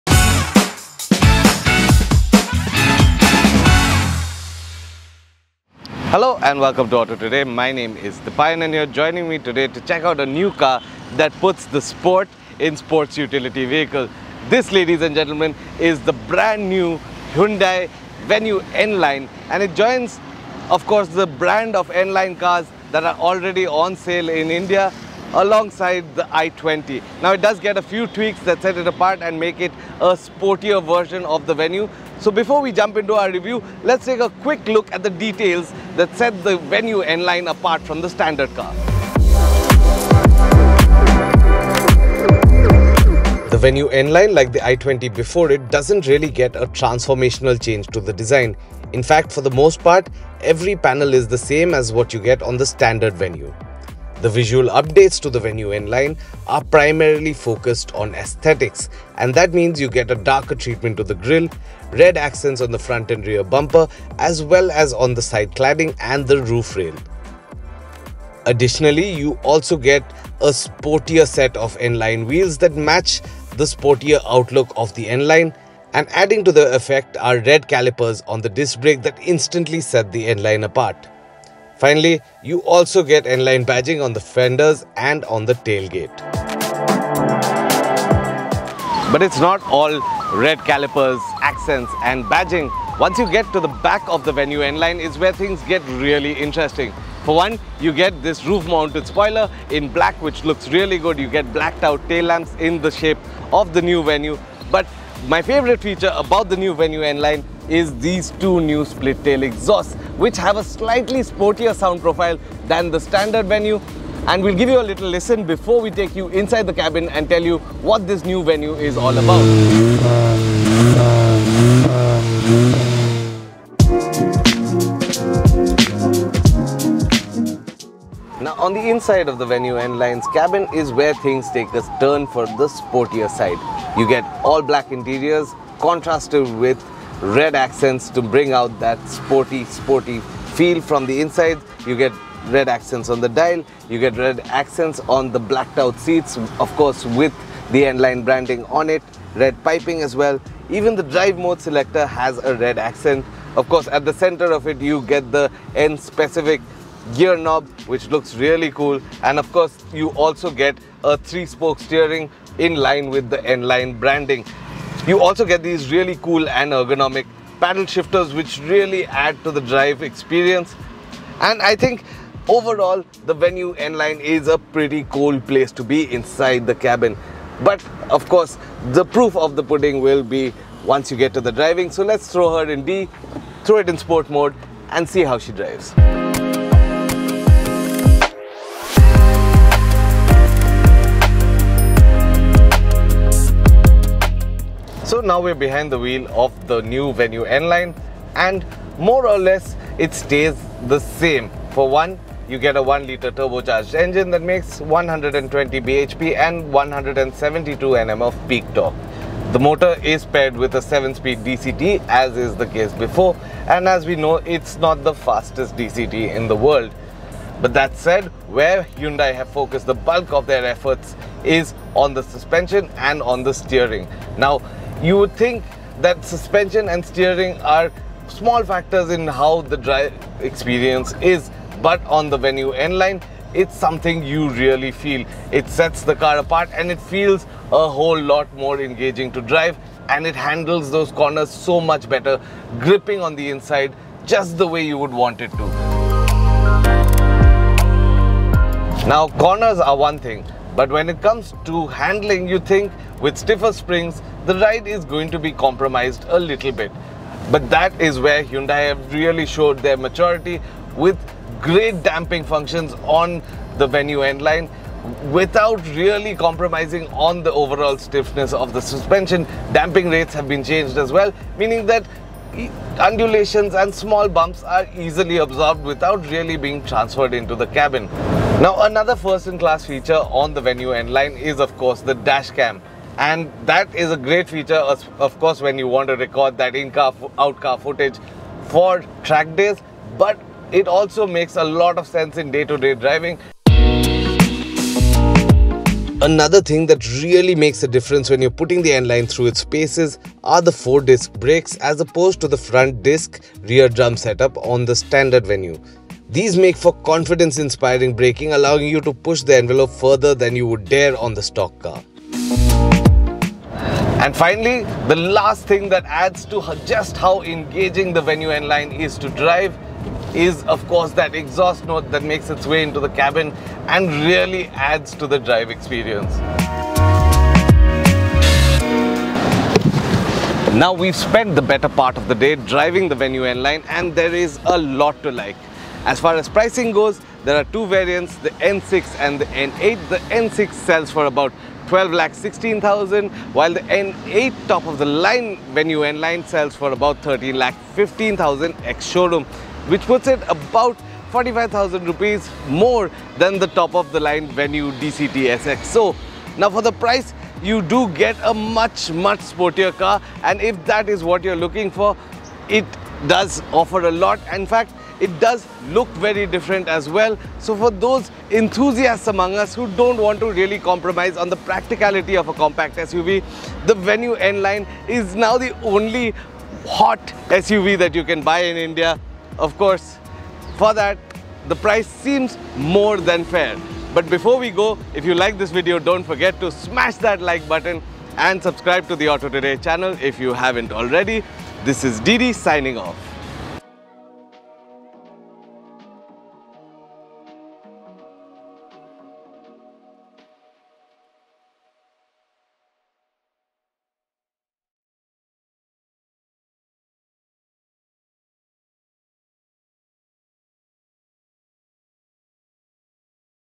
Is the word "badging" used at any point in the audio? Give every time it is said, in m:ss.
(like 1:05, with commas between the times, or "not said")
1:23, 1:32.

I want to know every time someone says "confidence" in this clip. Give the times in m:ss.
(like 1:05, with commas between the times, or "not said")
5:07.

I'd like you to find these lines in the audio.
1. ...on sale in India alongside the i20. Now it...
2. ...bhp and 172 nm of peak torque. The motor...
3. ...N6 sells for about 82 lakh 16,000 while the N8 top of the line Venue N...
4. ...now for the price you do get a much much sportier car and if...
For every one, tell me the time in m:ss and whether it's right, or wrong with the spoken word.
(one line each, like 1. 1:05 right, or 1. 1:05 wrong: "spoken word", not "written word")
1. 0:23 right
2. 3:25 right
3. 5:40 wrong: "12", not "82"
4. 5:56 right.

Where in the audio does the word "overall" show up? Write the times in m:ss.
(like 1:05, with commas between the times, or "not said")
2:52, 4:27.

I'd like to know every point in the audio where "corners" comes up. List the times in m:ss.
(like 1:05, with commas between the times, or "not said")
4:01, 4:09.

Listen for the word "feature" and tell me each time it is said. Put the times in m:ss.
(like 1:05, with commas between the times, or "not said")
1:45, 4:39, 4:44.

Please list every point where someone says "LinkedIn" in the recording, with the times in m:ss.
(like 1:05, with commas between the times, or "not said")
not said.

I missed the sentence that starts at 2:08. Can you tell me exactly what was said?
Now on the inside of the venue N-Line's cabin is where things take a turn for the sportier side.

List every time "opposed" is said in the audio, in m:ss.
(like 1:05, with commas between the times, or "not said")
5:02.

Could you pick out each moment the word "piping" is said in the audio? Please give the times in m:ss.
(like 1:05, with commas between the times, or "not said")
2:29.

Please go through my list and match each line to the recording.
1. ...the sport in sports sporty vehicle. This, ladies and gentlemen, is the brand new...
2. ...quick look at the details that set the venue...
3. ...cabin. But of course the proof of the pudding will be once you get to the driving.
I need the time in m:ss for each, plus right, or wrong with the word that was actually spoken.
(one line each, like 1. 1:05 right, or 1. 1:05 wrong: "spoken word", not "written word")
1. 0:11 wrong: "utility", not "sporty"
2. 0:34 right
3. 2:56 right.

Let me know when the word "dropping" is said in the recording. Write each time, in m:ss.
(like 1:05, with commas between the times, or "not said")
not said.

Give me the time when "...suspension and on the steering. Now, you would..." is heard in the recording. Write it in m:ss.
3:42.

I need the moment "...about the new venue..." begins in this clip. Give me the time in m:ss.
1:46.